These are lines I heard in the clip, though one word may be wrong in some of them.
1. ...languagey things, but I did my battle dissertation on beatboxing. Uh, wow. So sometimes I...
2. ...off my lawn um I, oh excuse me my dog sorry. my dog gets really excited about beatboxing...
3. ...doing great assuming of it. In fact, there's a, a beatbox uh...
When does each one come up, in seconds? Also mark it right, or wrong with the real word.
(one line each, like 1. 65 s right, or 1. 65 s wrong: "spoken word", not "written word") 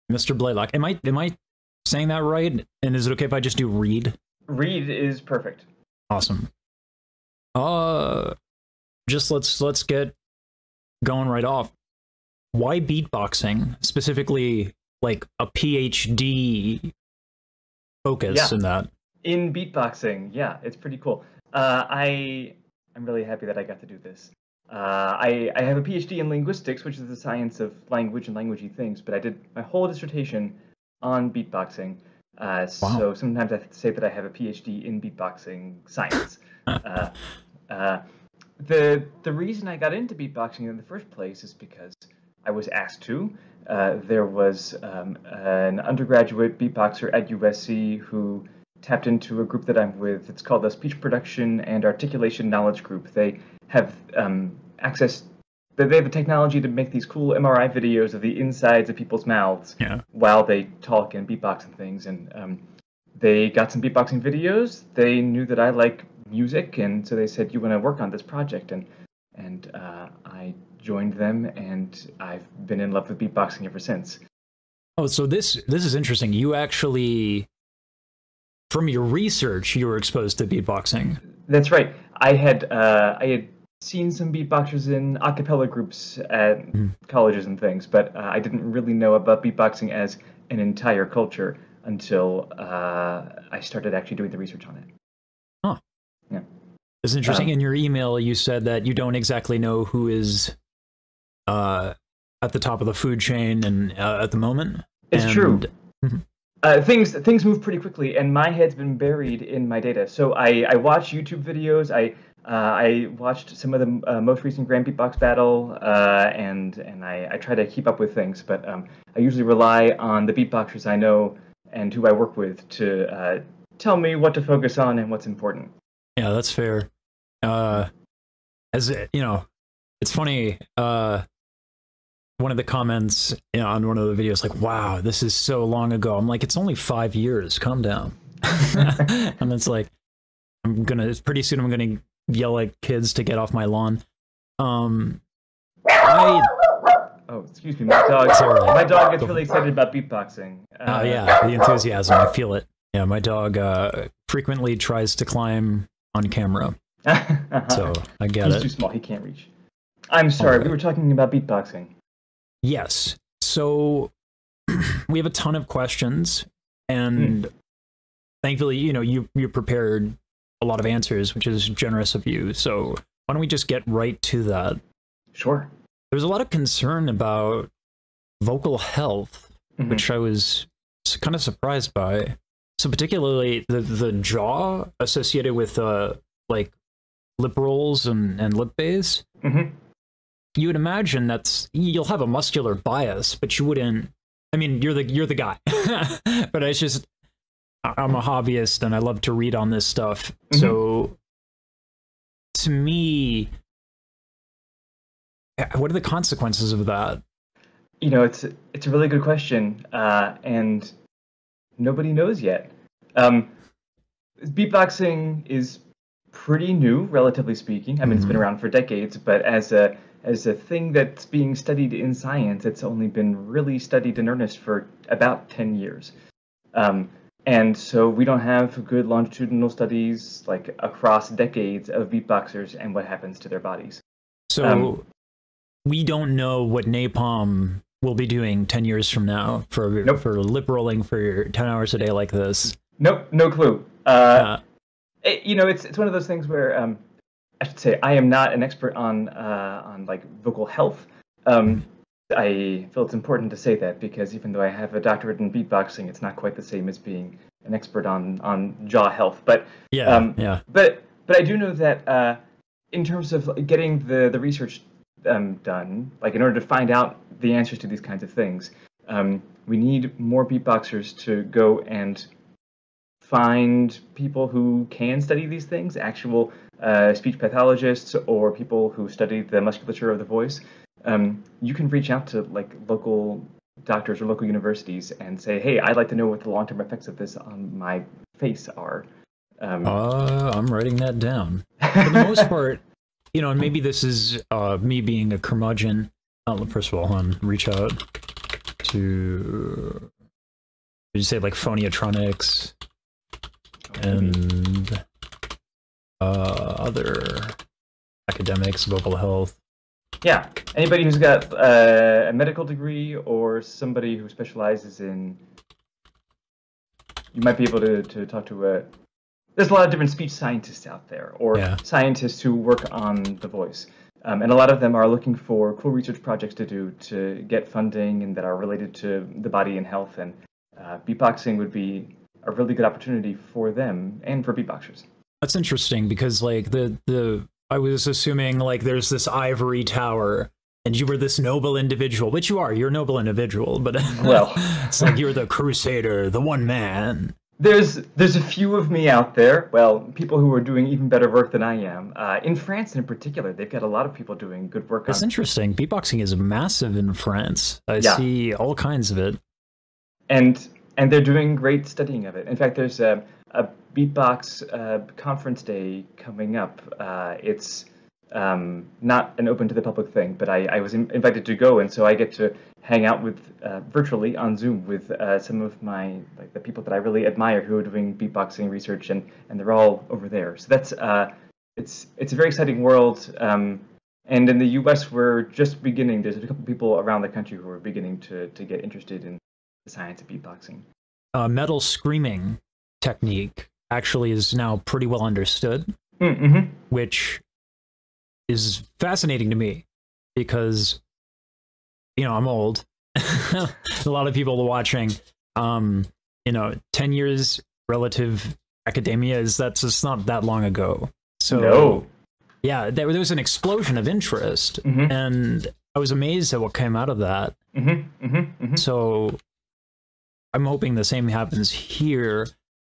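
1. 28 s wrong: "whole", not "battle"
2. 143 s right
3. 361 s wrong: "studying", not "assuming".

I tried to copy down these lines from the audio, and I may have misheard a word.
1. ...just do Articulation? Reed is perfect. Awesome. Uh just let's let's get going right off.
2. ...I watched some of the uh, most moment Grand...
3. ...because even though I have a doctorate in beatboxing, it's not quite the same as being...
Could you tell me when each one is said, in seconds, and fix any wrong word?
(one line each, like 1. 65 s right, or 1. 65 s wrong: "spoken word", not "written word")
1. 3 s wrong: "Reed", not "Articulation"
2. 112 s wrong: "recent", not "moment"
3. 253 s right.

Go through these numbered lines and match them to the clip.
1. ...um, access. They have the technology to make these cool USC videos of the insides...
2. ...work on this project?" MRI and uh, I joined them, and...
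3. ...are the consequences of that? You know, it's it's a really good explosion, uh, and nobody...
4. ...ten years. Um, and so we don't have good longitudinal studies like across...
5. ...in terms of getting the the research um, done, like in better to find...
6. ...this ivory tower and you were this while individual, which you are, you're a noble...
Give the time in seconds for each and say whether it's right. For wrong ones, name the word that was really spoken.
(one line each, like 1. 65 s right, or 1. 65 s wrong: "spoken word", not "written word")
1. 54 s wrong: "MRI", not "USC"
2. 67 s wrong: "And", not "MRI"
3. 205 s wrong: "question", not "explosion"
4. 225 s right
5. 262 s wrong: "order", not "better"
6. 339 s wrong: "noble", not "while".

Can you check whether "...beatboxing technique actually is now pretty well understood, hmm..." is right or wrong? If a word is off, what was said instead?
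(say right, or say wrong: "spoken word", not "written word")
wrong: "screaming", not "beatboxing".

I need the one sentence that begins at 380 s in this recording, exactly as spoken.
So that's uh, it's it's a very exciting world.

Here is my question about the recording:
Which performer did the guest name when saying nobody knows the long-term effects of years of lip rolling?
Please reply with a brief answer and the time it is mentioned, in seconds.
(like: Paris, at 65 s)
NaPoM, at 236 s.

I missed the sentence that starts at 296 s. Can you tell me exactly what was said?
Uh, first of all, hold reach out to.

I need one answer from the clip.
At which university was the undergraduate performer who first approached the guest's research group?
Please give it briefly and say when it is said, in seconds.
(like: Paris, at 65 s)
USC, at 47 s.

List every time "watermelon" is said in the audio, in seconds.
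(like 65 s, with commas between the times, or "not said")
not said.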